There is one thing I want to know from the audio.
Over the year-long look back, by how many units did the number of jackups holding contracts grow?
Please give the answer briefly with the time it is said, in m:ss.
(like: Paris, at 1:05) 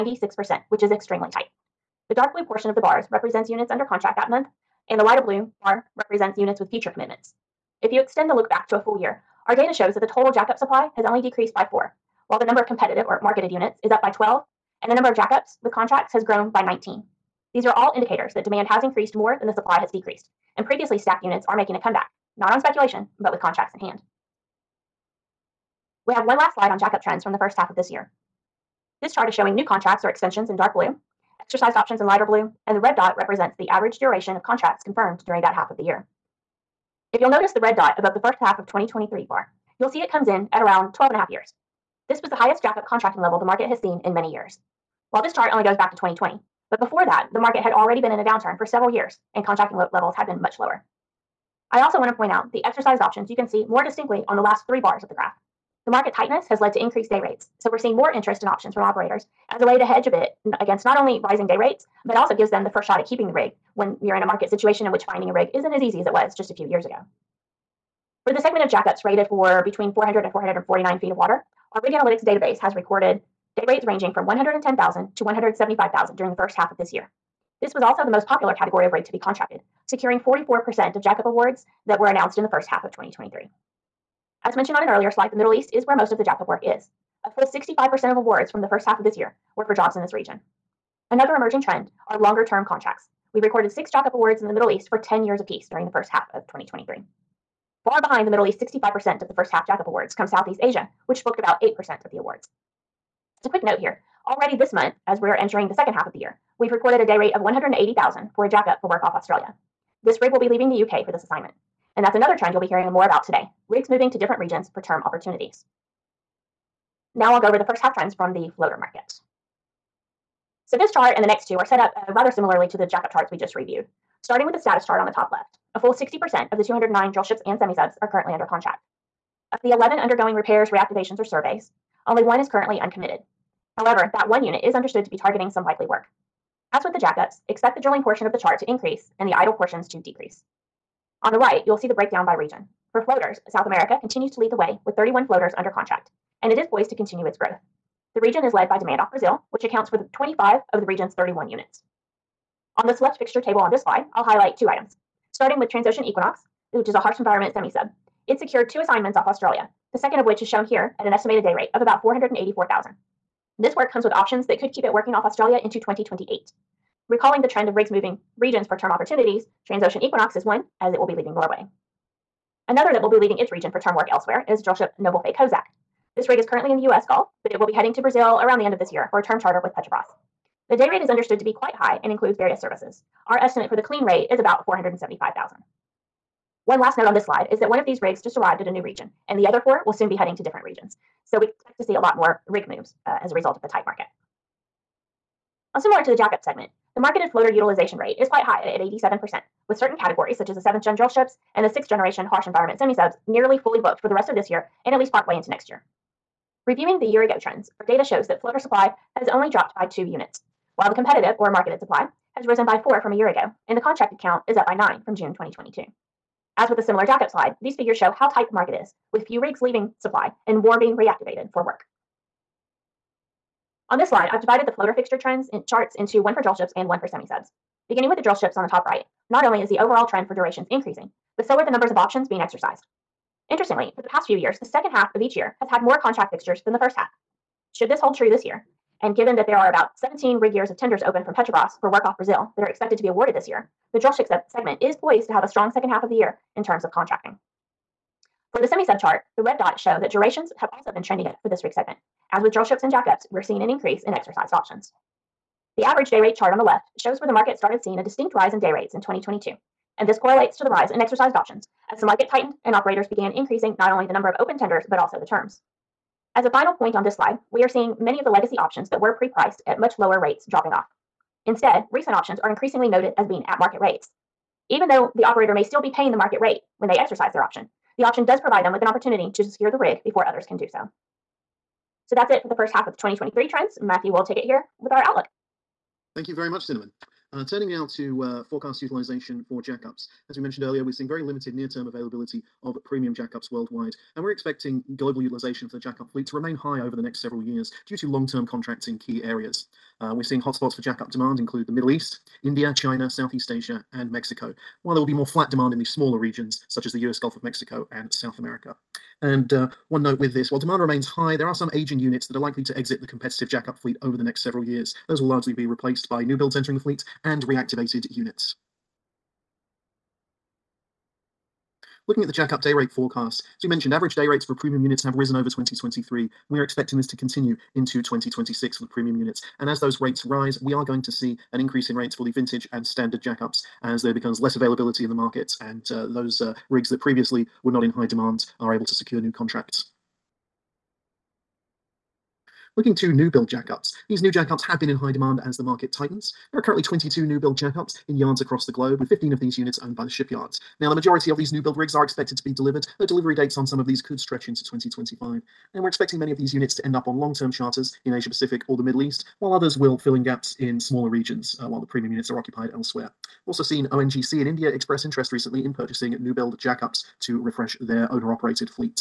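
19, at 0:16.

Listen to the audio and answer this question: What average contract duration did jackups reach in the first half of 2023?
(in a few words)
12.5 years.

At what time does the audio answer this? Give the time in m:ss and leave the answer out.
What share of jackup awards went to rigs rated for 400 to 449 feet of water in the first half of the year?
1:20.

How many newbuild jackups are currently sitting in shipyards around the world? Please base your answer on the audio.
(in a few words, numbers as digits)
22.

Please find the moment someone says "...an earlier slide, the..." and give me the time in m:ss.
1:24.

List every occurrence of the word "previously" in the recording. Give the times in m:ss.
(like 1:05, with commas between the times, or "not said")
0:20, 5:36.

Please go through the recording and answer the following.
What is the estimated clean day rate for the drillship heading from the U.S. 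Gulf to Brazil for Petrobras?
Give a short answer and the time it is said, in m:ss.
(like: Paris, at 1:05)
475,000, at 3:04.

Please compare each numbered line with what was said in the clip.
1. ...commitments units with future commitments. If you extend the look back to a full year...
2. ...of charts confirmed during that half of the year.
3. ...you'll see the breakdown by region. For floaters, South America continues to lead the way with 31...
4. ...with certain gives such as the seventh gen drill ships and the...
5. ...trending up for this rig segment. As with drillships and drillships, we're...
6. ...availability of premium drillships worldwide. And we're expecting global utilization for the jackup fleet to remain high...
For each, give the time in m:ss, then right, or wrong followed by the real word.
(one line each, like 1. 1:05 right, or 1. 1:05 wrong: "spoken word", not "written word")
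1. 0:05 wrong: "represents", not "commitments"
2. 0:34 wrong: "contracts", not "charts"
3. 2:21 right
4. 3:19 wrong: "categories", not "gives"
5. 4:11 wrong: "jackups", not "drillships"
6. 4:51 wrong: "jackups", not "drillships".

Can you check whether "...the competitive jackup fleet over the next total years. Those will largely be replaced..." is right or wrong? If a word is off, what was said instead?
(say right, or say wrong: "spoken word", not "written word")
wrong: "several", not "total".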